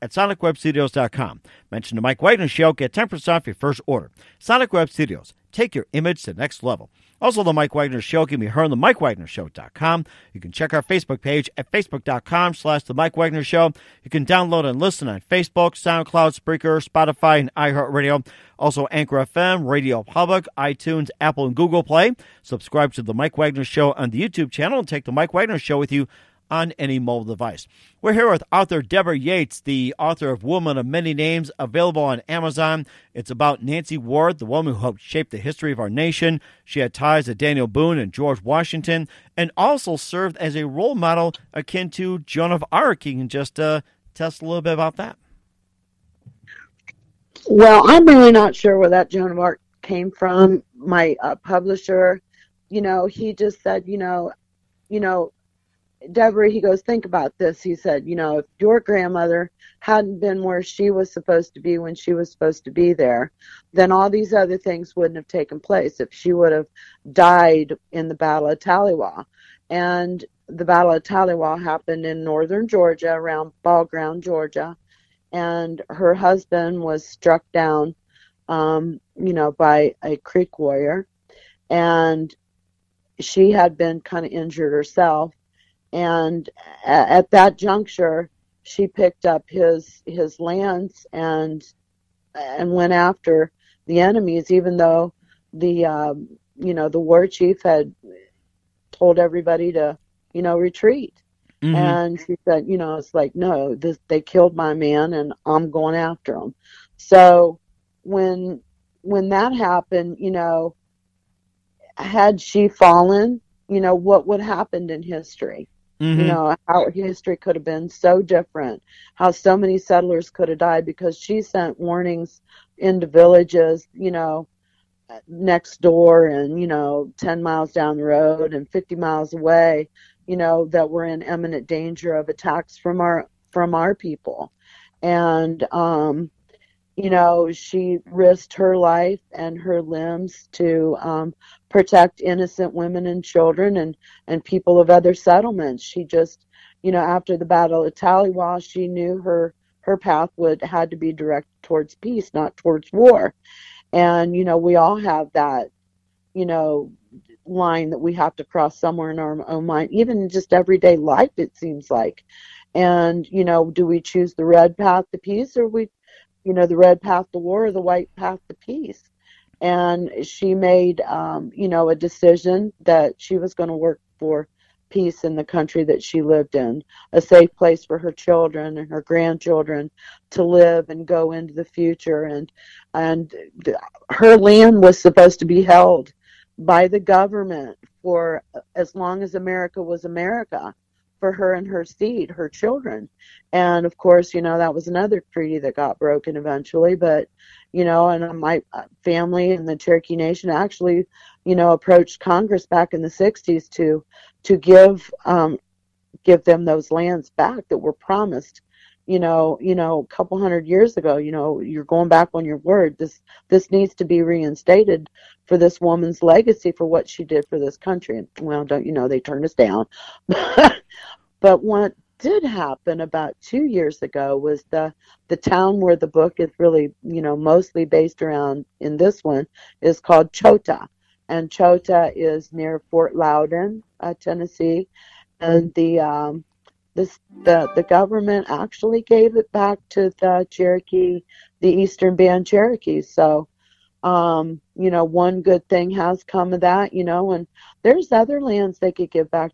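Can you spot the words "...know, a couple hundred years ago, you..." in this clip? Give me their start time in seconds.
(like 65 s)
209 s.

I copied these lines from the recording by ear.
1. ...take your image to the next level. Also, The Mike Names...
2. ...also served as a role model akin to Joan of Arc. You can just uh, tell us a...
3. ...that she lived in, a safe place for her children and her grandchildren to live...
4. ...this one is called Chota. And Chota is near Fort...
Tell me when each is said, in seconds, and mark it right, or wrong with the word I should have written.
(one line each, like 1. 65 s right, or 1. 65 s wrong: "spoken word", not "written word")
1. 5 s wrong: "Wagner", not "Names"
2. 39 s right
3. 175 s right
4. 228 s right.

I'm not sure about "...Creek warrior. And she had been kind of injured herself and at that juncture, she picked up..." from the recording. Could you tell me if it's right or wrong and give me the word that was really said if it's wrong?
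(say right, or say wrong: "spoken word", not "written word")
right.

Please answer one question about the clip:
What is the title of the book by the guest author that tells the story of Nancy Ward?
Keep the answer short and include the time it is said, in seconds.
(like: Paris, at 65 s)
Woman of Many Names, at 30 s.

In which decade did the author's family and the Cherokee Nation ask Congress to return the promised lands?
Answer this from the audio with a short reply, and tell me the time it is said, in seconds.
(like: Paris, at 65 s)
1960s, at 203 s.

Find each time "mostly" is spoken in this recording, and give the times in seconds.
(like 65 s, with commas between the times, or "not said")
227 s.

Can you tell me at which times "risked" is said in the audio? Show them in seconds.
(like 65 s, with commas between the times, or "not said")
138 s.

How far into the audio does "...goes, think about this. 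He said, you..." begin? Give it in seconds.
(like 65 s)
56 s.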